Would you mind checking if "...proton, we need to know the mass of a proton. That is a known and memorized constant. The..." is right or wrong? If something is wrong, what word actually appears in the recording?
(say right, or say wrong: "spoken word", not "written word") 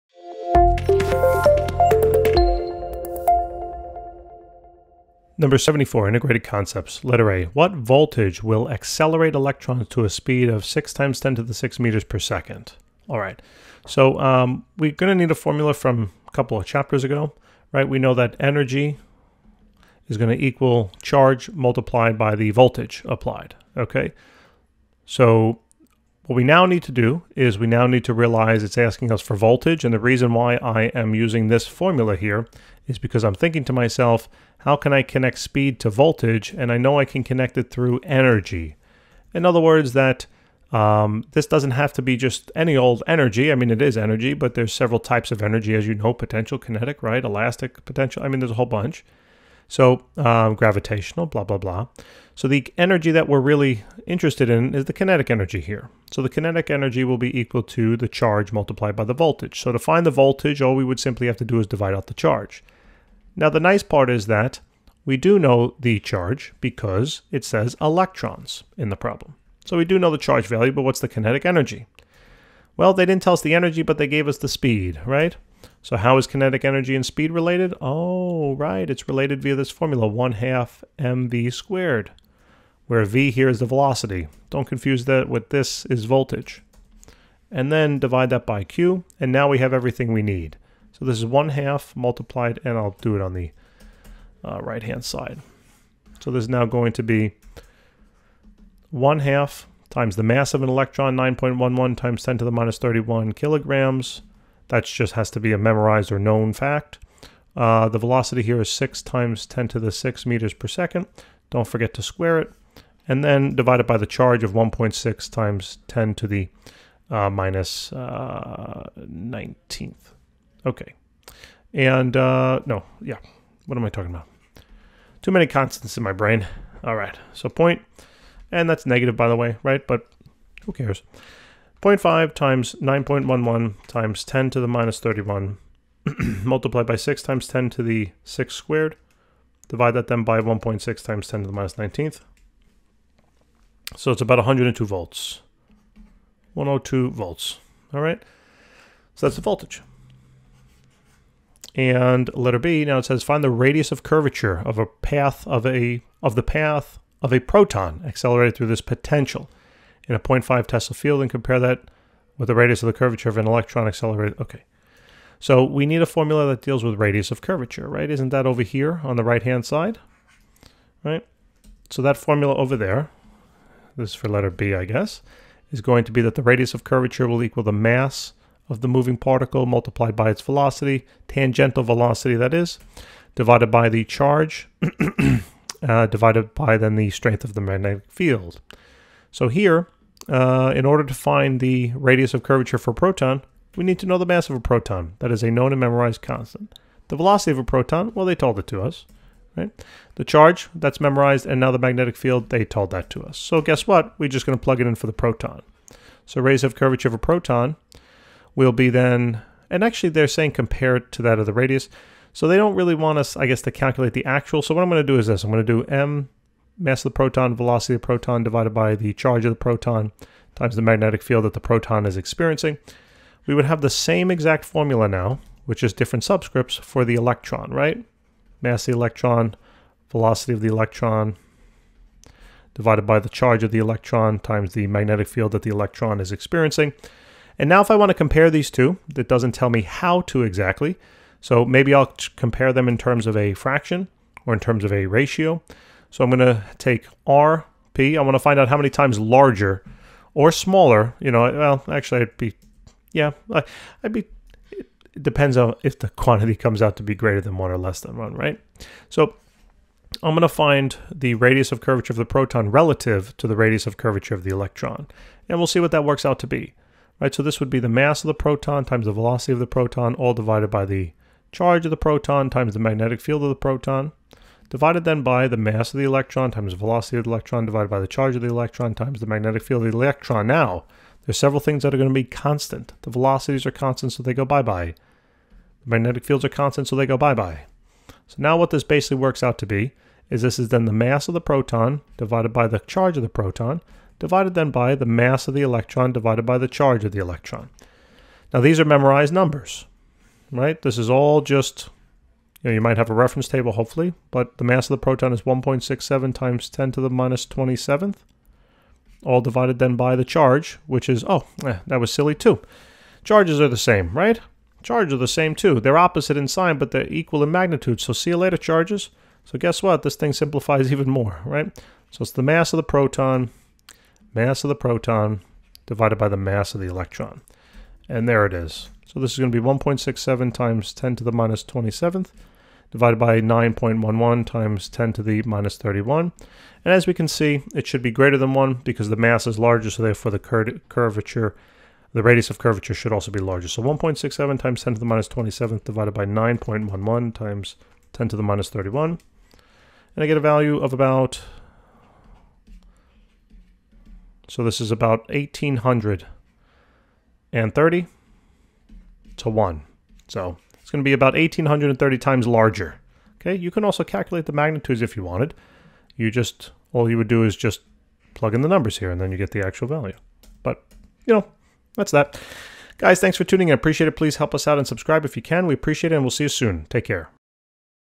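right.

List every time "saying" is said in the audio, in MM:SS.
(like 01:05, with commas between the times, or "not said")
03:30.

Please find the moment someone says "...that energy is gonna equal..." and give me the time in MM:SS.
00:18.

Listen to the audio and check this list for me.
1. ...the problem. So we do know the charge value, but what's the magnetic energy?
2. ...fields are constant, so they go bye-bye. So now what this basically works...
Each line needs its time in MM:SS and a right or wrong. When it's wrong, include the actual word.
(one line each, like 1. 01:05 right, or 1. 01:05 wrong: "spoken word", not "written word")
1. 01:08 wrong: "kinetic", not "magnetic"
2. 04:46 right.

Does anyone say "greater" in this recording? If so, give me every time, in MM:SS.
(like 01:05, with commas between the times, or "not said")
04:17, 05:38.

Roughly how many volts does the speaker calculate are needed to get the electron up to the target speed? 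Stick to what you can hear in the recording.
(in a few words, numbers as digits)
102 volts.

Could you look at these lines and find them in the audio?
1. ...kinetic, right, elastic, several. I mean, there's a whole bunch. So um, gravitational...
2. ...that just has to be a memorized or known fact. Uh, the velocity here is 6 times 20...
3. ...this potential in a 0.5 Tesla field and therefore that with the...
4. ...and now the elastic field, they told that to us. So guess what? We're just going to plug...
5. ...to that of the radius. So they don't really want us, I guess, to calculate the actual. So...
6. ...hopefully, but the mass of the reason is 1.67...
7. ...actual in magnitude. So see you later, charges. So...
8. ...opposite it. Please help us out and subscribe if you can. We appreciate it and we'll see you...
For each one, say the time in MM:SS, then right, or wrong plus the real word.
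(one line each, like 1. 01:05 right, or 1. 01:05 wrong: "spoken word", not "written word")
1. 00:46 wrong: "potential", not "several"
2. 01:44 wrong: "10", not "20"
3. 02:38 wrong: "compare", not "therefore"
4. 03:21 wrong: "magnetic", not "elastic"
5. 03:31 right
6. 05:03 wrong: "proton", not "reason"
7. 05:17 wrong: "equal", not "actual"
8. 06:13 wrong: "appreciate", not "opposite".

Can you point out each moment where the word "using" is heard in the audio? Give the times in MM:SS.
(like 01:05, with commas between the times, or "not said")
00:31.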